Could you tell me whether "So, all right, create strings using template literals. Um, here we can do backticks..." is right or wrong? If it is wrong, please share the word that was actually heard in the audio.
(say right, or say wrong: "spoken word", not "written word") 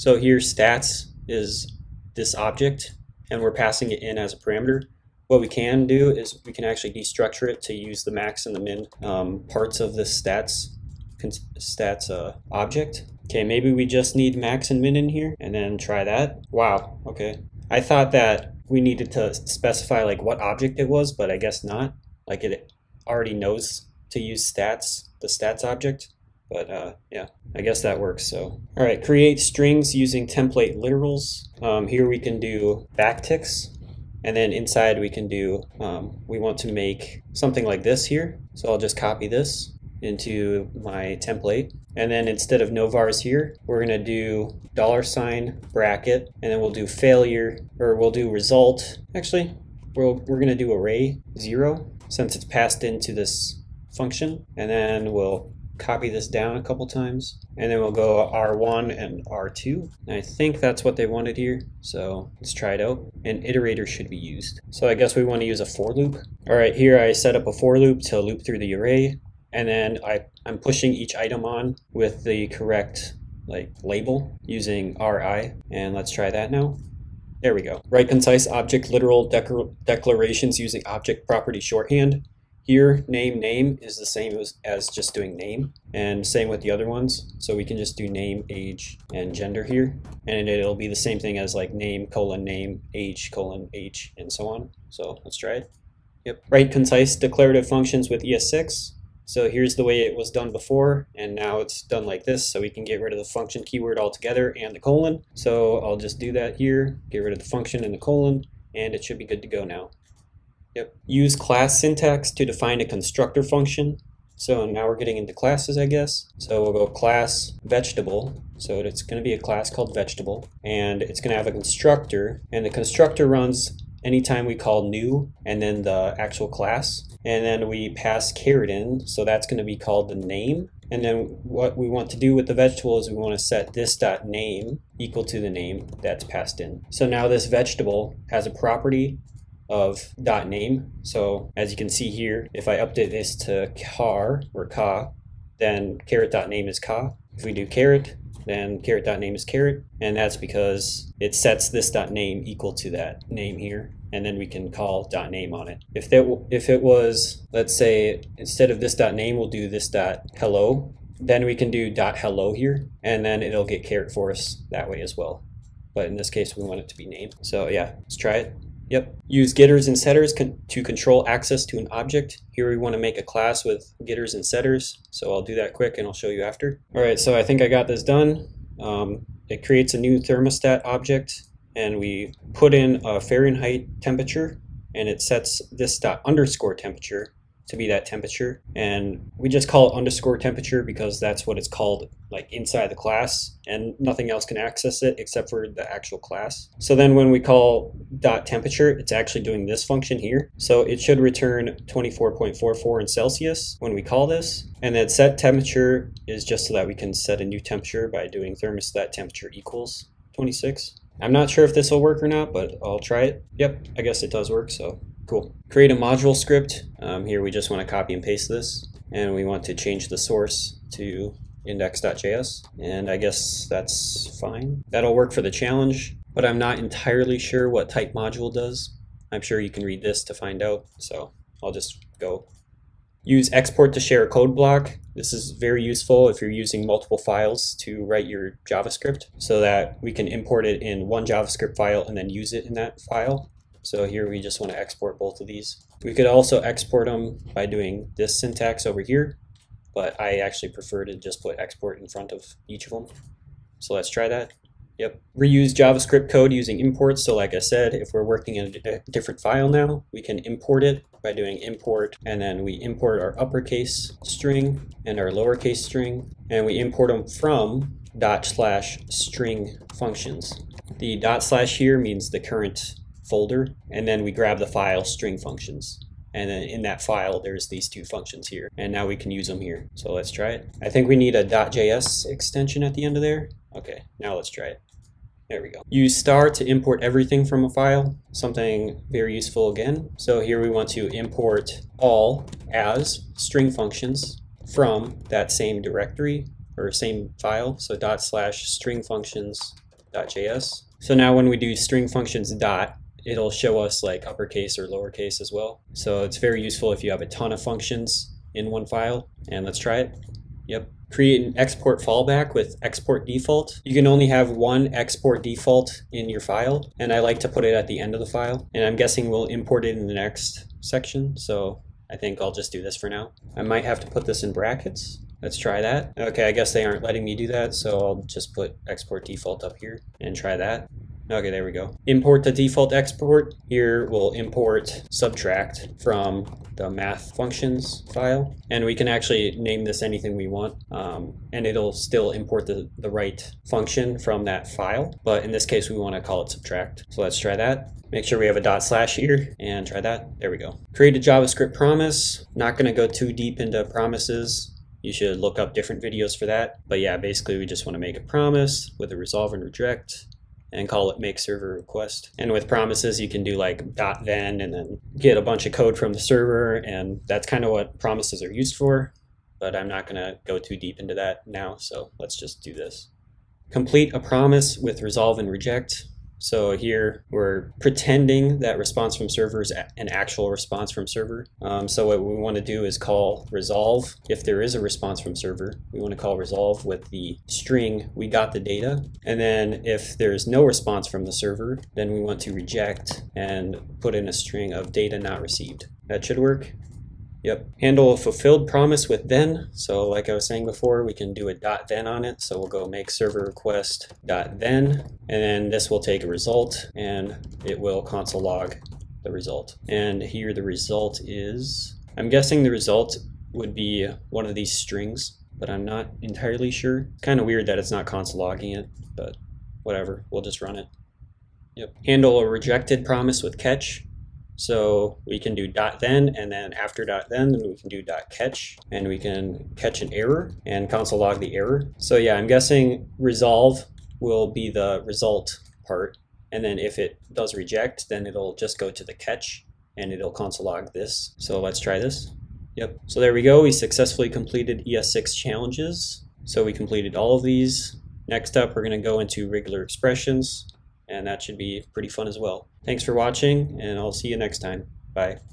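right.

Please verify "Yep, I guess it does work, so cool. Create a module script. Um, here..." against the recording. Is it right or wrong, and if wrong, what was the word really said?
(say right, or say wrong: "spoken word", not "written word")
right.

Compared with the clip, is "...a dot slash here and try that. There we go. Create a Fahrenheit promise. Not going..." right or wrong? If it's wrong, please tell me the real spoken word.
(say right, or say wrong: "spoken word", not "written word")
wrong: "JavaScript", not "Fahrenheit".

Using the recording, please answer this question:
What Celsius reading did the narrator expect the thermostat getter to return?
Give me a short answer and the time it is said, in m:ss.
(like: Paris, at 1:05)
24.44, at 3:21.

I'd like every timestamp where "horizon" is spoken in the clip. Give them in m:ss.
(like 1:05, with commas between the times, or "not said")
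not said.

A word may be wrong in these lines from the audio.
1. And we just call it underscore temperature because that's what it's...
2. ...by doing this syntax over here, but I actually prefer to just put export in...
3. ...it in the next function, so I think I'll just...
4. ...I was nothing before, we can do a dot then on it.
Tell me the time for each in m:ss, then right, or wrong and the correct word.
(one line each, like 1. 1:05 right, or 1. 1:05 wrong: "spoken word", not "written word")
1. 3:08 right
2. 4:07 right
3. 5:19 wrong: "section", not "function"
4. 6:40 wrong: "saying", not "nothing".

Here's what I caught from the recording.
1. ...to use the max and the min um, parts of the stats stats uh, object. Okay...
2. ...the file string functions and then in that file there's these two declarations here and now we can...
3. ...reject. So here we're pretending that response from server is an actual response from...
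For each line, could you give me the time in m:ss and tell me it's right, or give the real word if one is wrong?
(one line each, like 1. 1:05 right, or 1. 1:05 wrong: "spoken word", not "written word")
1. 0:07 right
2. 4:34 wrong: "functions", not "declarations"
3. 6:15 right.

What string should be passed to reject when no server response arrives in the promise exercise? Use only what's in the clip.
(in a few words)
data not received.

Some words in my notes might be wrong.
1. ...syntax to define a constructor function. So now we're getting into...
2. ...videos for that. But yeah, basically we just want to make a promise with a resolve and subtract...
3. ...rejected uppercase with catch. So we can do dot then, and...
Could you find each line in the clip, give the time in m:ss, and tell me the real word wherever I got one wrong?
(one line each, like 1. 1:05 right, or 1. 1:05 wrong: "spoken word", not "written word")
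1. 1:51 right
2. 5:56 wrong: "reject", not "subtract"
3. 7:02 wrong: "promise", not "uppercase".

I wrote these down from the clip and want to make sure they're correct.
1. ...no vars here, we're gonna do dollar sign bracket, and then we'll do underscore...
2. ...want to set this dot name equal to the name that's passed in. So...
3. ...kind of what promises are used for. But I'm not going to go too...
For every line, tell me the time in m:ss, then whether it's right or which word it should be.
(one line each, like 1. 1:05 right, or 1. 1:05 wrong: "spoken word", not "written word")
1. 0:42 wrong: "failure", not "underscore"
2. 2:13 right
3. 6:07 right.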